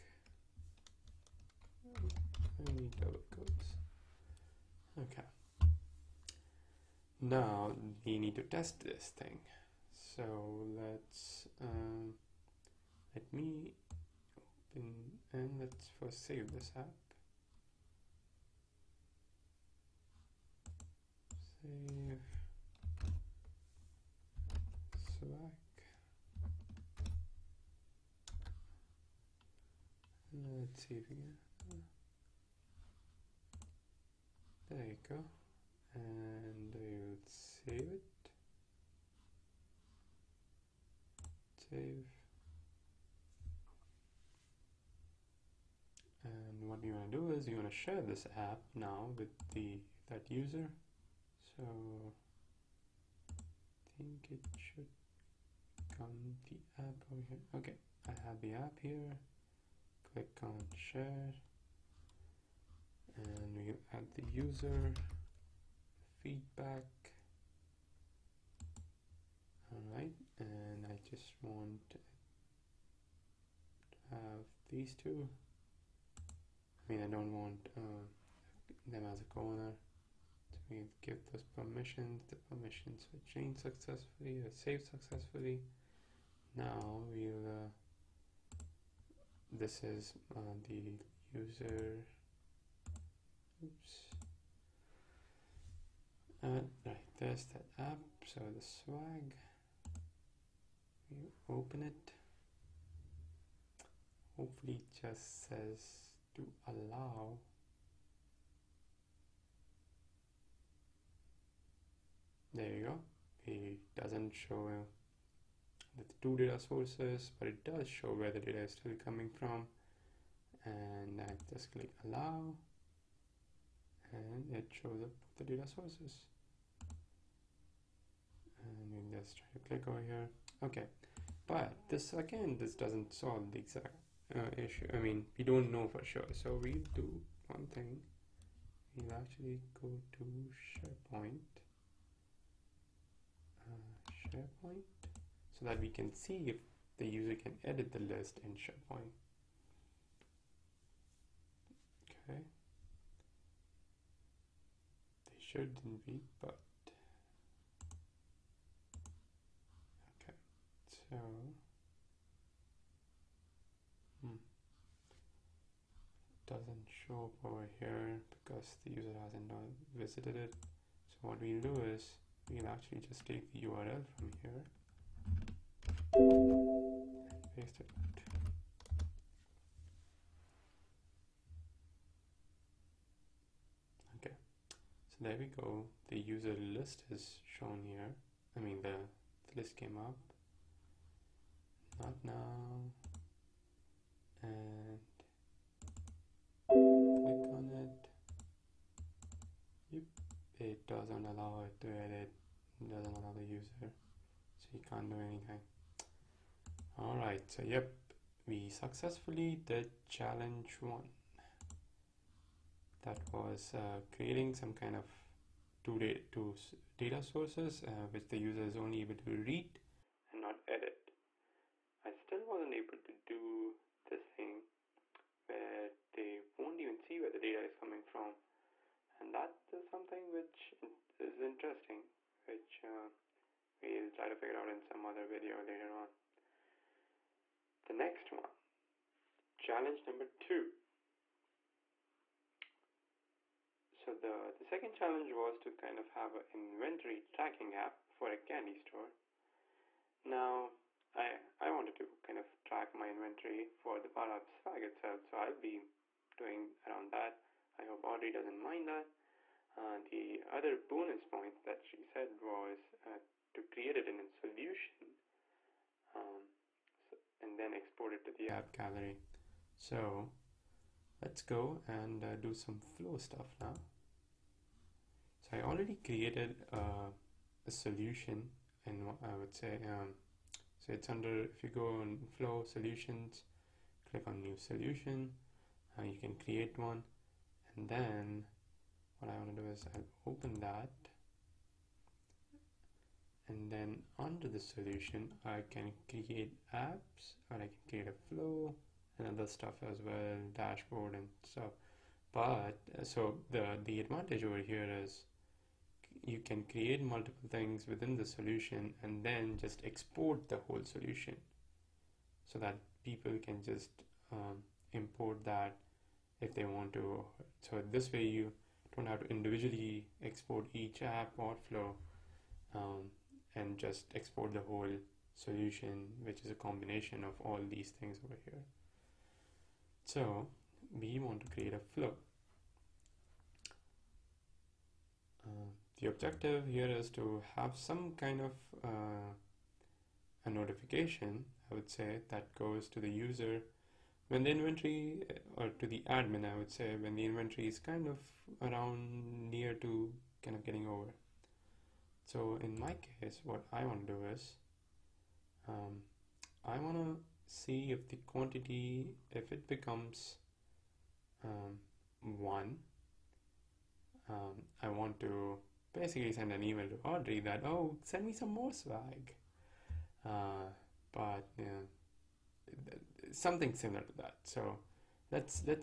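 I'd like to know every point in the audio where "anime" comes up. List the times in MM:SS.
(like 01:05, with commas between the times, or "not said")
not said.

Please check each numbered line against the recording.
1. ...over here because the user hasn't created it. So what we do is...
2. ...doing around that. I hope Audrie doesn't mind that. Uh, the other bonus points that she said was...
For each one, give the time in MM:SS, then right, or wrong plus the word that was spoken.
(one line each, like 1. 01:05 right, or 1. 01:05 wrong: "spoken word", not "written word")
1. 02:47 wrong: "visited", not "created"
2. 04:16 right.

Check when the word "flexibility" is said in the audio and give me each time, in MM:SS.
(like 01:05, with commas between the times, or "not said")
not said.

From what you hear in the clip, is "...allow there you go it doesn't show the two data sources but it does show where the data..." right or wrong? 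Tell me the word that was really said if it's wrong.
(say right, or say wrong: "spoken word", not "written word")
right.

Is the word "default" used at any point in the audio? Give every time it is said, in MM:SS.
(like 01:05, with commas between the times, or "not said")
not said.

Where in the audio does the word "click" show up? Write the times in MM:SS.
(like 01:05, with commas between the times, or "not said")
01:00, 02:01, 02:09, 03:16, 04:44.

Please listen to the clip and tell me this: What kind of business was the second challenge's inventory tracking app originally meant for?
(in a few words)
candy store.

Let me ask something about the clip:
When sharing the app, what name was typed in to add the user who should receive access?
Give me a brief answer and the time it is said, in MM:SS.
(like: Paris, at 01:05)
feedback, at 01:06.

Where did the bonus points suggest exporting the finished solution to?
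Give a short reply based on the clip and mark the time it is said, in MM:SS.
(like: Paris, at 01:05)
app gallery, at 04:28.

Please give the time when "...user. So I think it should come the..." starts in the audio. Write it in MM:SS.
00:50.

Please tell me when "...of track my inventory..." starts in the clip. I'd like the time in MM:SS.
04:12.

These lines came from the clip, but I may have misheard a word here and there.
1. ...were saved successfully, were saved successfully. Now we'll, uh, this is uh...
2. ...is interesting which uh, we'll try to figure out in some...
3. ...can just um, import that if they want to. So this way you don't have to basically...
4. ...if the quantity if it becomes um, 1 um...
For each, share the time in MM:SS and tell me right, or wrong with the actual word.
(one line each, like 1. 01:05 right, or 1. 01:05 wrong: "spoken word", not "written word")
1. 01:23 wrong: "changed", not "saved"
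2. 03:51 right
3. 05:13 wrong: "individually", not "basically"
4. 05:57 right.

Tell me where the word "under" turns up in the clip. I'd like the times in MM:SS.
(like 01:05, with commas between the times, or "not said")
04:41, 04:54.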